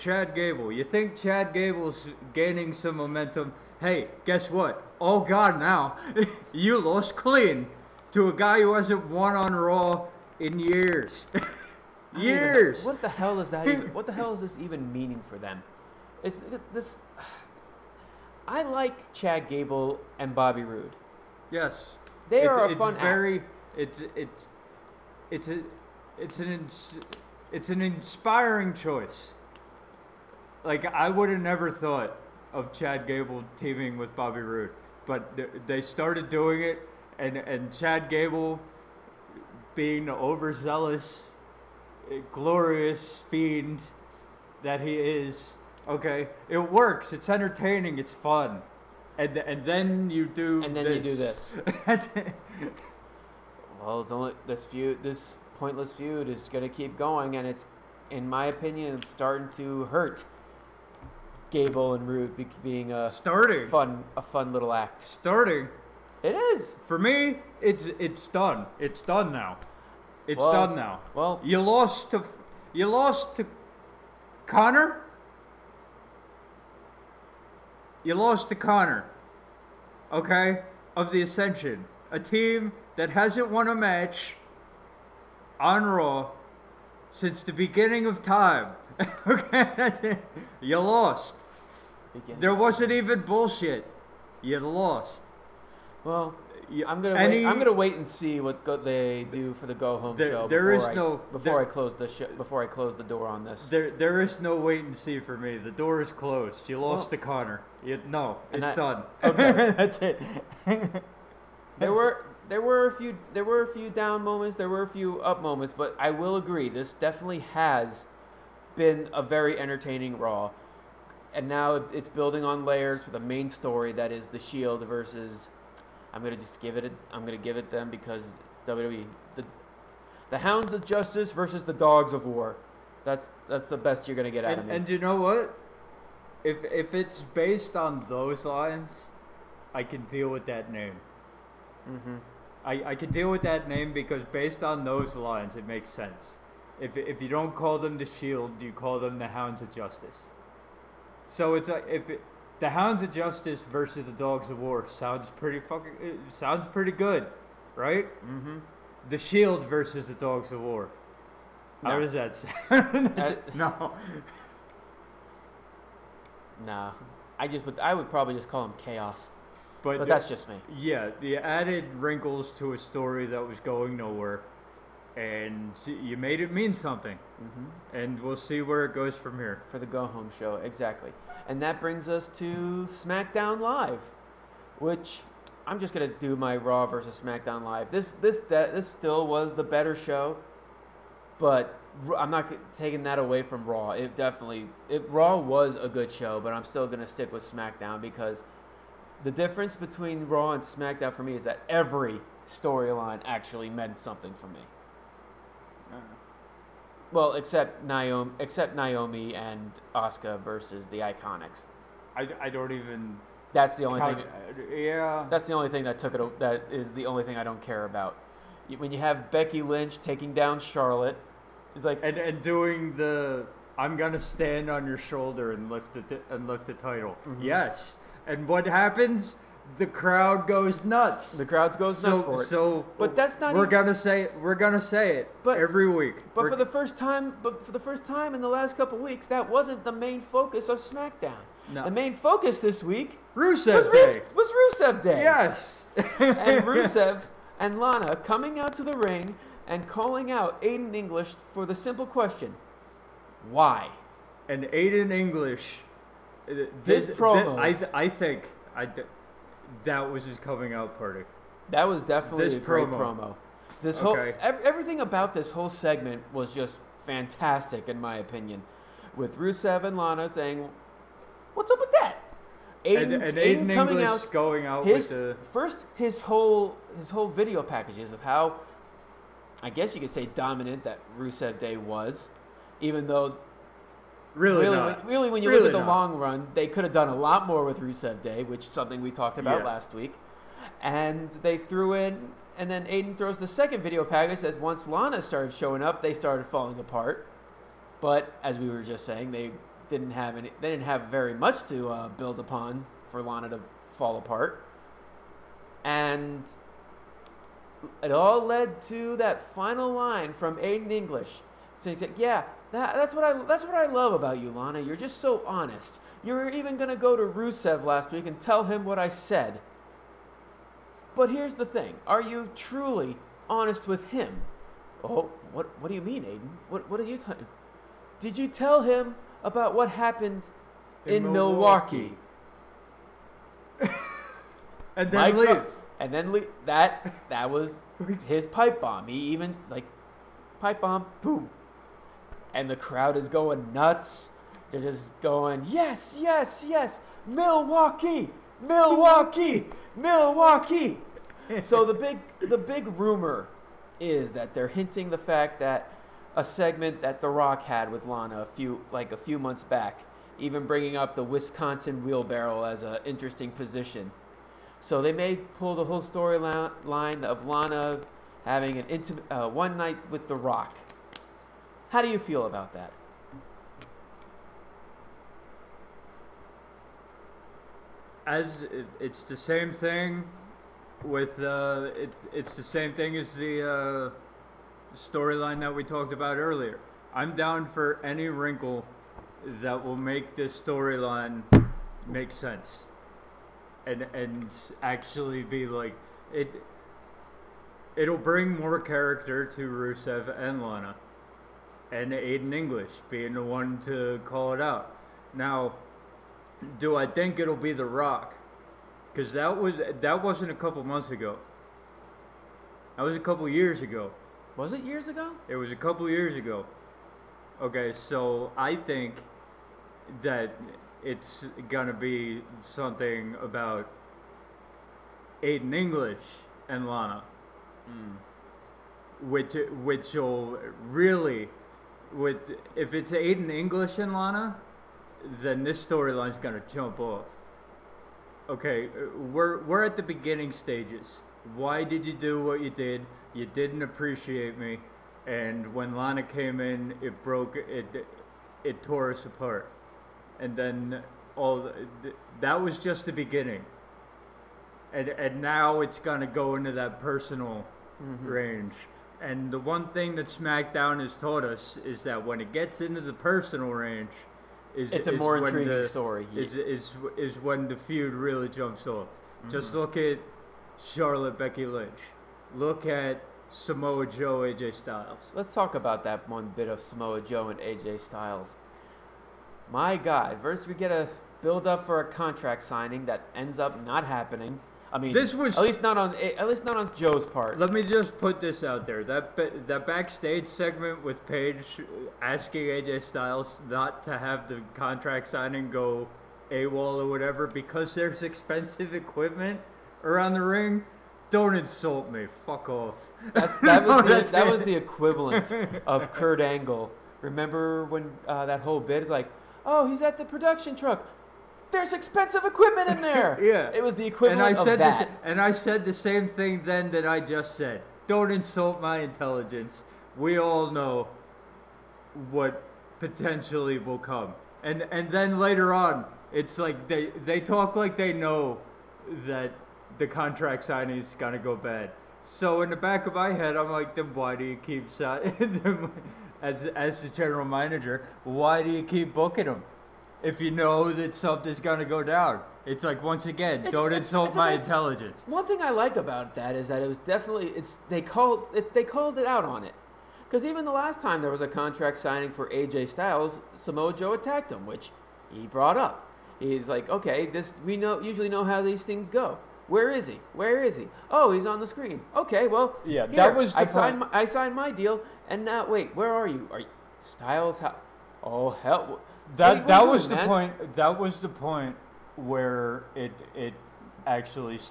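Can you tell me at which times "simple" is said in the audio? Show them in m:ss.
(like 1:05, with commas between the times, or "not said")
4:11.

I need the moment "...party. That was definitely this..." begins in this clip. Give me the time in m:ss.
4:20.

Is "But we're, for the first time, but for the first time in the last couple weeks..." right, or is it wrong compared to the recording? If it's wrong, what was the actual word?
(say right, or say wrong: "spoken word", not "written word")
right.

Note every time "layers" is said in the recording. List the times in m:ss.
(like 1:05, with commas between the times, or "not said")
2:02.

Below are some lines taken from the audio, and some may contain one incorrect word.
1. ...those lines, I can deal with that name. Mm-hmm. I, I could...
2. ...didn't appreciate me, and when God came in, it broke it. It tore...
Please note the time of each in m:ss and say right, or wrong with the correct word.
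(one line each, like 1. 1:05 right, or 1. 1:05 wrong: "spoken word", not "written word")
1. 2:18 right
2. 7:23 wrong: "Lana", not "God".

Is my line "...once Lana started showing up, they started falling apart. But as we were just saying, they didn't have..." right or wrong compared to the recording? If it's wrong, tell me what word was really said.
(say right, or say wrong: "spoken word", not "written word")
right.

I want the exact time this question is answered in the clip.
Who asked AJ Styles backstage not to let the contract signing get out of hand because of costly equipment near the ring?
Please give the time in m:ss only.
8:11.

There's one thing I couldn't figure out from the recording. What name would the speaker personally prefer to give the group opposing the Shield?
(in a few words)
Chaos.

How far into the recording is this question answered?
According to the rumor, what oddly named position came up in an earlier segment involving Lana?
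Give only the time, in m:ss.
6:01.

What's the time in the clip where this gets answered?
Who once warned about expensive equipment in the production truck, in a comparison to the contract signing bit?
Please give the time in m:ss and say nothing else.
8:26.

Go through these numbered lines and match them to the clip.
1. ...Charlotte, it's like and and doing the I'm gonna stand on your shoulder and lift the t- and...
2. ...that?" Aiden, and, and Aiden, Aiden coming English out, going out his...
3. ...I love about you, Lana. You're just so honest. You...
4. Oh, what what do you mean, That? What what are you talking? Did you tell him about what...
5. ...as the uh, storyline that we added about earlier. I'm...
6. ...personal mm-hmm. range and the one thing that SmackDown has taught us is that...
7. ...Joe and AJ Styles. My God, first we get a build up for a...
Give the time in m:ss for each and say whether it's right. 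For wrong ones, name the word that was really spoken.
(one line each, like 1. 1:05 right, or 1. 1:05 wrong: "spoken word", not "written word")
1. 3:40 right
2. 4:31 right
3. 5:13 right
4. 5:25 wrong: "Aiden", not "That"
5. 6:23 wrong: "talked", not "added"
6. 7:36 right
7. 7:57 right.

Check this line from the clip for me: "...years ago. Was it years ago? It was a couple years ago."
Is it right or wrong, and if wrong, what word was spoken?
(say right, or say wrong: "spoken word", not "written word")
right.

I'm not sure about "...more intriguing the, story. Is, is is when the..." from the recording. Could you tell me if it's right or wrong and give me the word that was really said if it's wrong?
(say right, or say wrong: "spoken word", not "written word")
right.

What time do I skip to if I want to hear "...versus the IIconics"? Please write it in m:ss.
3:30.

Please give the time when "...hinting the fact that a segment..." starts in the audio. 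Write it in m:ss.
5:54.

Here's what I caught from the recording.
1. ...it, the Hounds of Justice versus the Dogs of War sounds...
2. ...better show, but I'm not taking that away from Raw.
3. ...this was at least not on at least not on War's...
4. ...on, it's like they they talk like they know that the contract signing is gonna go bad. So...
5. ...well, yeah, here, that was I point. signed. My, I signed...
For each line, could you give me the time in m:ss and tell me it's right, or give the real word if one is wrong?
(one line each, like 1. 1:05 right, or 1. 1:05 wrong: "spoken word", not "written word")
1. 2:32 right
2. 3:09 right
3. 8:05 wrong: "Joe", not "War"
4. 8:45 right
5. 9:22 right.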